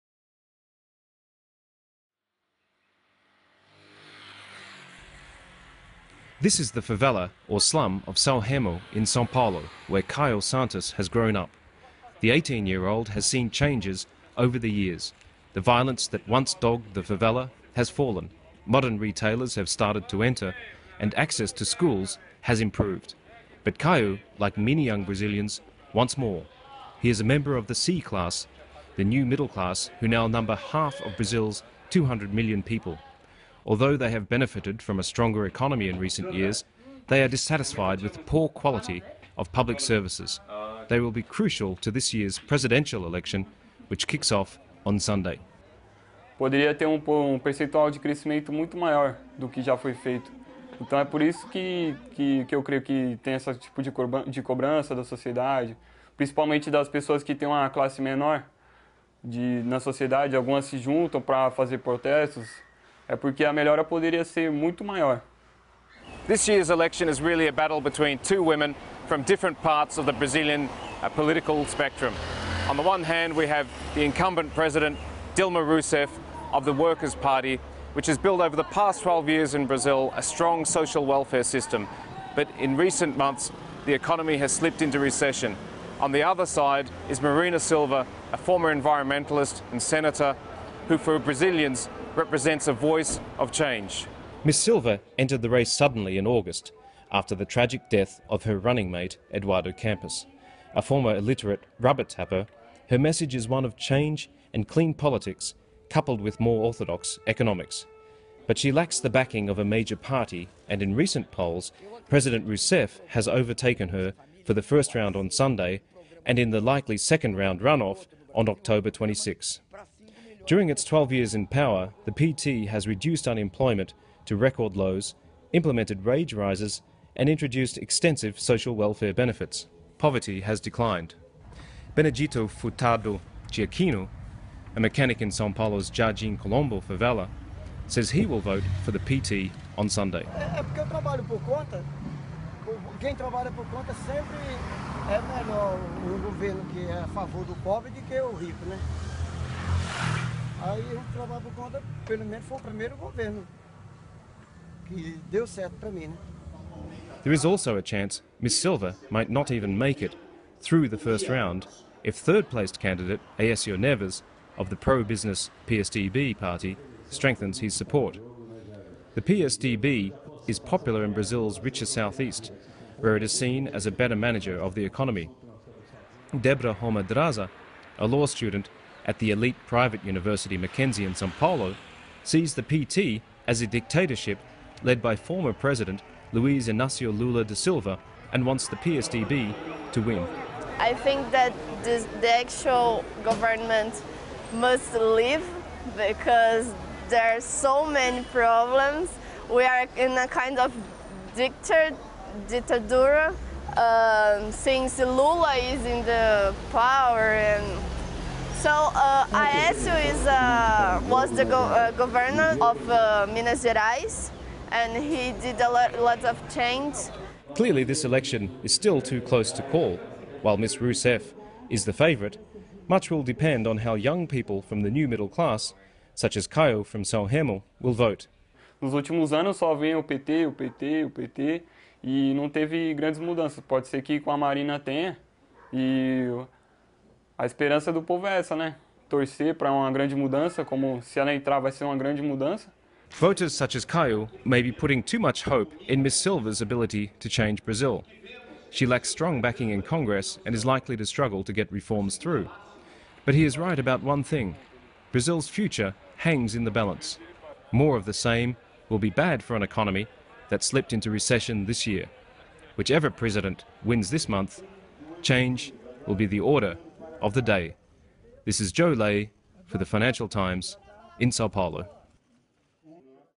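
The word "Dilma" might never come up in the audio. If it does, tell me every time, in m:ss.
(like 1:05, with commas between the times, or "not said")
1:15.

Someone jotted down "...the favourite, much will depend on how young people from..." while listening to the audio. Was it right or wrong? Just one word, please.
right.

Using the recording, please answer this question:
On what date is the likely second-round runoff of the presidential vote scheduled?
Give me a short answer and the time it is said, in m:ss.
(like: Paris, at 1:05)
October 26, at 1:58.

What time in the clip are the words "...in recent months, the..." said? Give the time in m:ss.
1:22.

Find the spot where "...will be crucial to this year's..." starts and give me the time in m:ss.
0:40.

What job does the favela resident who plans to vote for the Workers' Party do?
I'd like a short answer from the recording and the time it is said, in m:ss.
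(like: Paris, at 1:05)
Mechanic, at 2:14.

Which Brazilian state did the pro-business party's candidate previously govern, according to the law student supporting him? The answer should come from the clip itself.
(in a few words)
Minas Gerais.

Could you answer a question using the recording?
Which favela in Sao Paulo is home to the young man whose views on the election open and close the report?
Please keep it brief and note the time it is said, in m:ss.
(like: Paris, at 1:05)
Sao Remo, at 0:08.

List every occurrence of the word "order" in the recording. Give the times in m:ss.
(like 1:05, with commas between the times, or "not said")
4:26.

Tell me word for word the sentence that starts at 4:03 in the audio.
Voters such as Caio may be putting too much hope in Ms Silva's ability to change Brazil.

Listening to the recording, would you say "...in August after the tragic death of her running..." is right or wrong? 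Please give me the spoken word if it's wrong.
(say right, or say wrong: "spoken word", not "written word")
right.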